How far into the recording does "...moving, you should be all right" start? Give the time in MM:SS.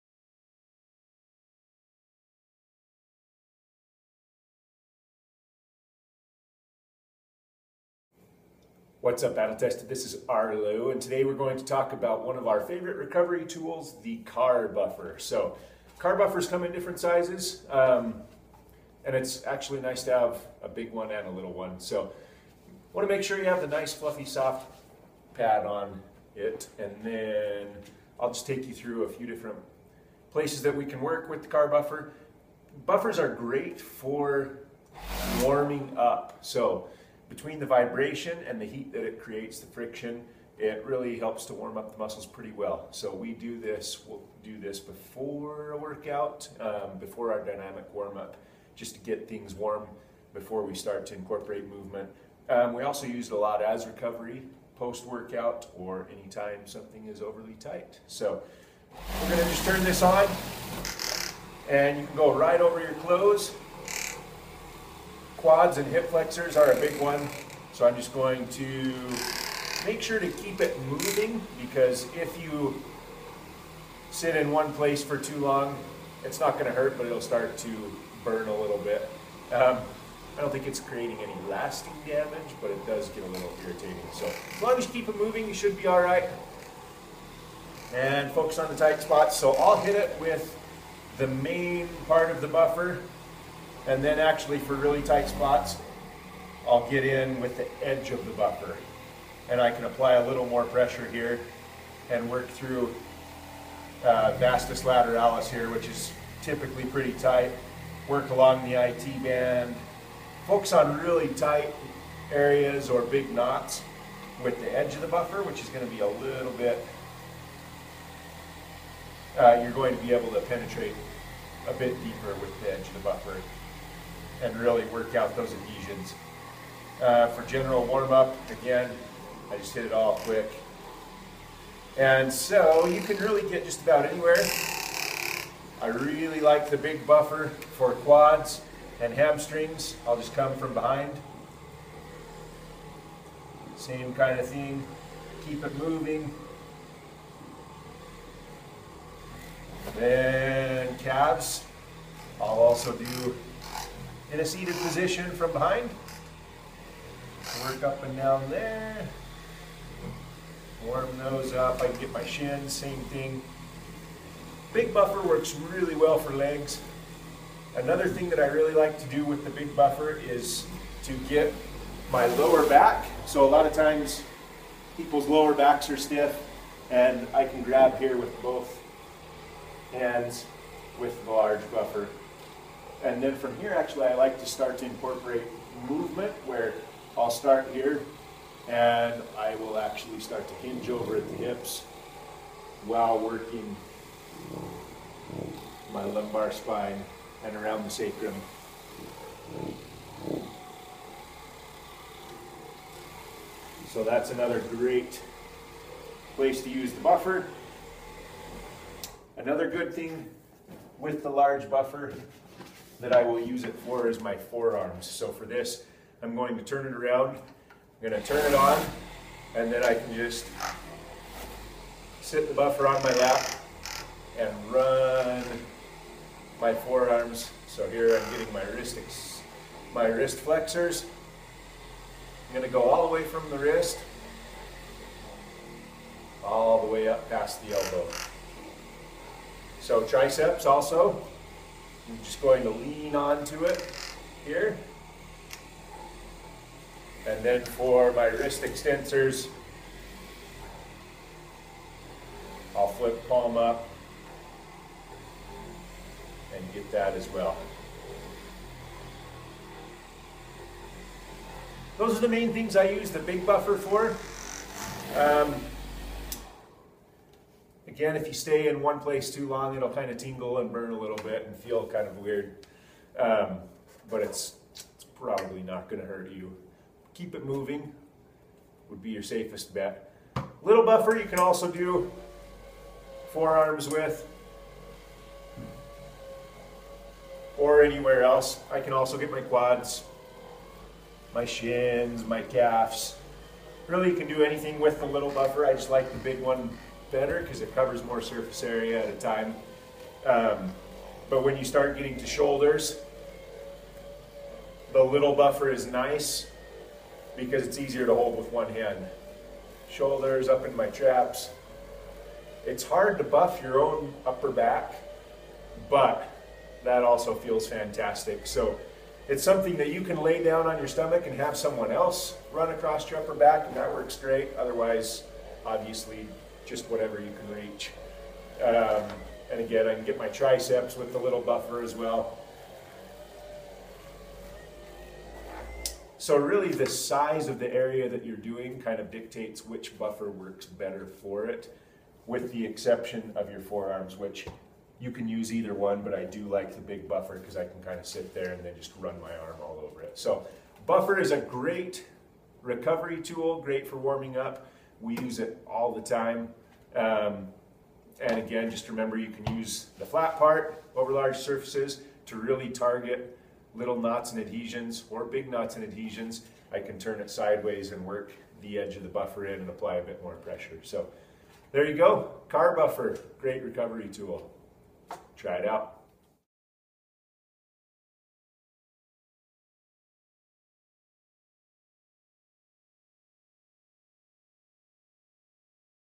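01:25.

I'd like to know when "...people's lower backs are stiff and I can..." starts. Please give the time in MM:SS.
02:54.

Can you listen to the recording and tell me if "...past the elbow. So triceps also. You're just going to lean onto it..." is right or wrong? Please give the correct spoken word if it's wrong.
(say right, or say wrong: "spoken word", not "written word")
right.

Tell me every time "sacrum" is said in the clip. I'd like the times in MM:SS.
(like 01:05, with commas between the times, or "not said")
03:17.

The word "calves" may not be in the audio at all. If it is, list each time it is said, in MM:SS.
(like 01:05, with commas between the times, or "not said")
02:30, 04:52.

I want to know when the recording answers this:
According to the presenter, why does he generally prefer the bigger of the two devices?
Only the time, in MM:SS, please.
04:57.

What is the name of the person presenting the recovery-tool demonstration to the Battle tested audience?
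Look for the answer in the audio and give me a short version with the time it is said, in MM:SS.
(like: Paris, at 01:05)
Arlo, at 00:10.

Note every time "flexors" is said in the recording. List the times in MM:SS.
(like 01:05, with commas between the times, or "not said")
01:06, 03:50.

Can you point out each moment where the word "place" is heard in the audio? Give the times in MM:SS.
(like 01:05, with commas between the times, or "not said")
00:30, 01:14, 03:26, 04:28.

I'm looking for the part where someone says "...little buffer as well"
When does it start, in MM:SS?
05:31.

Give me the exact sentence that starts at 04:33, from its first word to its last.
Um, but it's, it's probably not going to hurt you.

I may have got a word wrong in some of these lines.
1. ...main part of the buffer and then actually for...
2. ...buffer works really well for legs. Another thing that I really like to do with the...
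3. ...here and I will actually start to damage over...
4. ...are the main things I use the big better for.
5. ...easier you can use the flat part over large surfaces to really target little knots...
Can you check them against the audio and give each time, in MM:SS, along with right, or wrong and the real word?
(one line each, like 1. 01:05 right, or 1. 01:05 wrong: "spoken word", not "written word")
1. 01:31 right
2. 02:44 right
3. 03:07 wrong: "hinge", not "damage"
4. 04:22 wrong: "buffer", not "better"
5. 05:58 wrong: "remember", not "easier".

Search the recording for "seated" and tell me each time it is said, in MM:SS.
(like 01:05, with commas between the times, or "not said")
02:34.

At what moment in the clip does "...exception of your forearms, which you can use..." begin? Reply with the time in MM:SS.
05:42.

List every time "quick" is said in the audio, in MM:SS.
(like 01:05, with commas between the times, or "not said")
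02:10.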